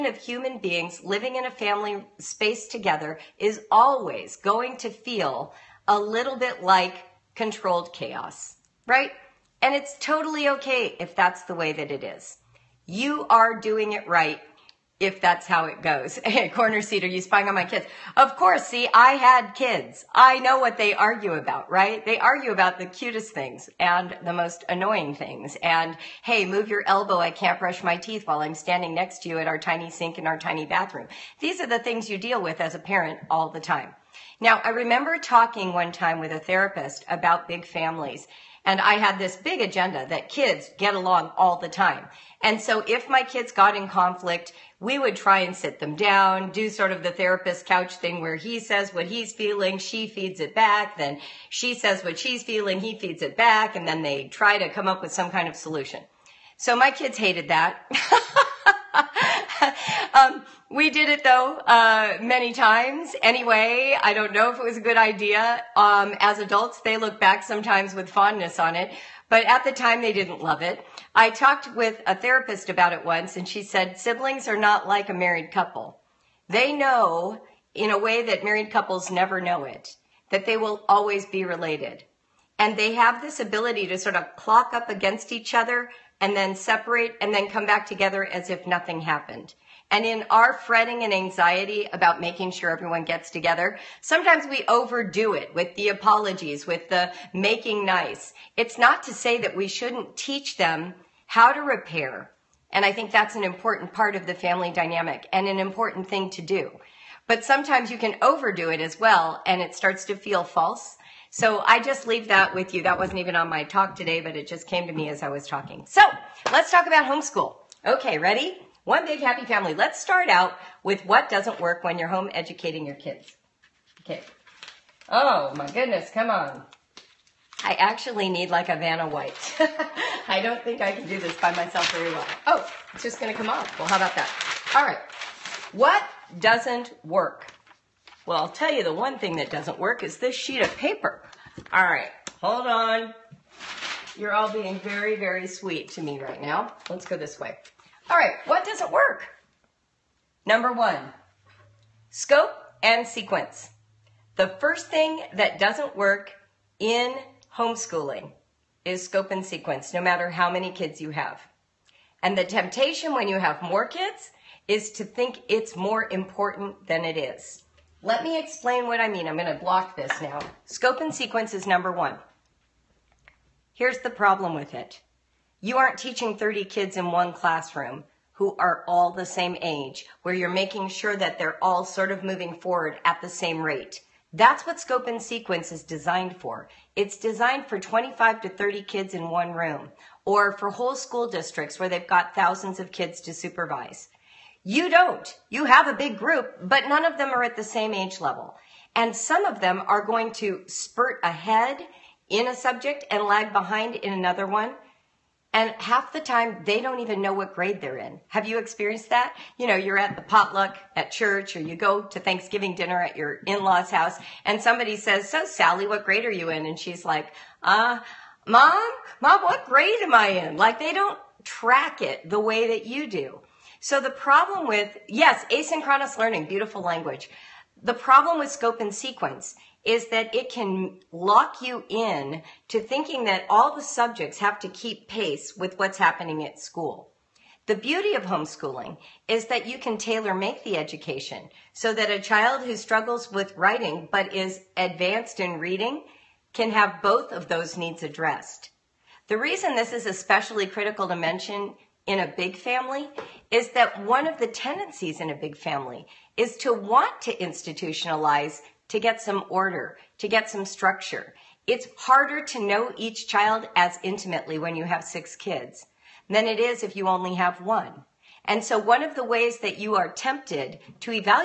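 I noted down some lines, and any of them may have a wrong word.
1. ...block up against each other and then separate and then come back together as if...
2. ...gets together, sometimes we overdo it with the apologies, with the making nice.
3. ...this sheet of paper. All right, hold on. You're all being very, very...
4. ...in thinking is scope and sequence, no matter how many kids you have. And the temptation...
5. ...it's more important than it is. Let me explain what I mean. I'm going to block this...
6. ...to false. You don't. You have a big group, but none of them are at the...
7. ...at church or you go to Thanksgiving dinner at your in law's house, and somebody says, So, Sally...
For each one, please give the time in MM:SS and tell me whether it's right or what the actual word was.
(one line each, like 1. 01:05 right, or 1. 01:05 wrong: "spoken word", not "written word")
1. 01:24 wrong: "clock", not "block"
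2. 01:33 right
3. 02:20 right
4. 02:36 wrong: "homeschooling", not "thinking"
5. 02:45 right
6. 03:13 wrong: "supervise", not "false"
7. 03:30 right.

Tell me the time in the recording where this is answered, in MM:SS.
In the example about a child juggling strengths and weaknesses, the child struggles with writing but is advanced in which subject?
04:05.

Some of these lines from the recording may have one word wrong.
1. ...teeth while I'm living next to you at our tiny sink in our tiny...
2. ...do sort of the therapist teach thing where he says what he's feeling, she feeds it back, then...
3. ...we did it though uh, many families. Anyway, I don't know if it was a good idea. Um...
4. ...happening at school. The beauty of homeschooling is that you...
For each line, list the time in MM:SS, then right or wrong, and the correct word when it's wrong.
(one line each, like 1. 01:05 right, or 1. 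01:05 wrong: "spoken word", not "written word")
1. 00:27 wrong: "standing", not "living"
2. 00:46 wrong: "couch", not "teach"
3. 01:00 wrong: "times", not "families"
4. 03:55 right.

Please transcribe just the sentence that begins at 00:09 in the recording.
And it's totally okay if that's the way that it is.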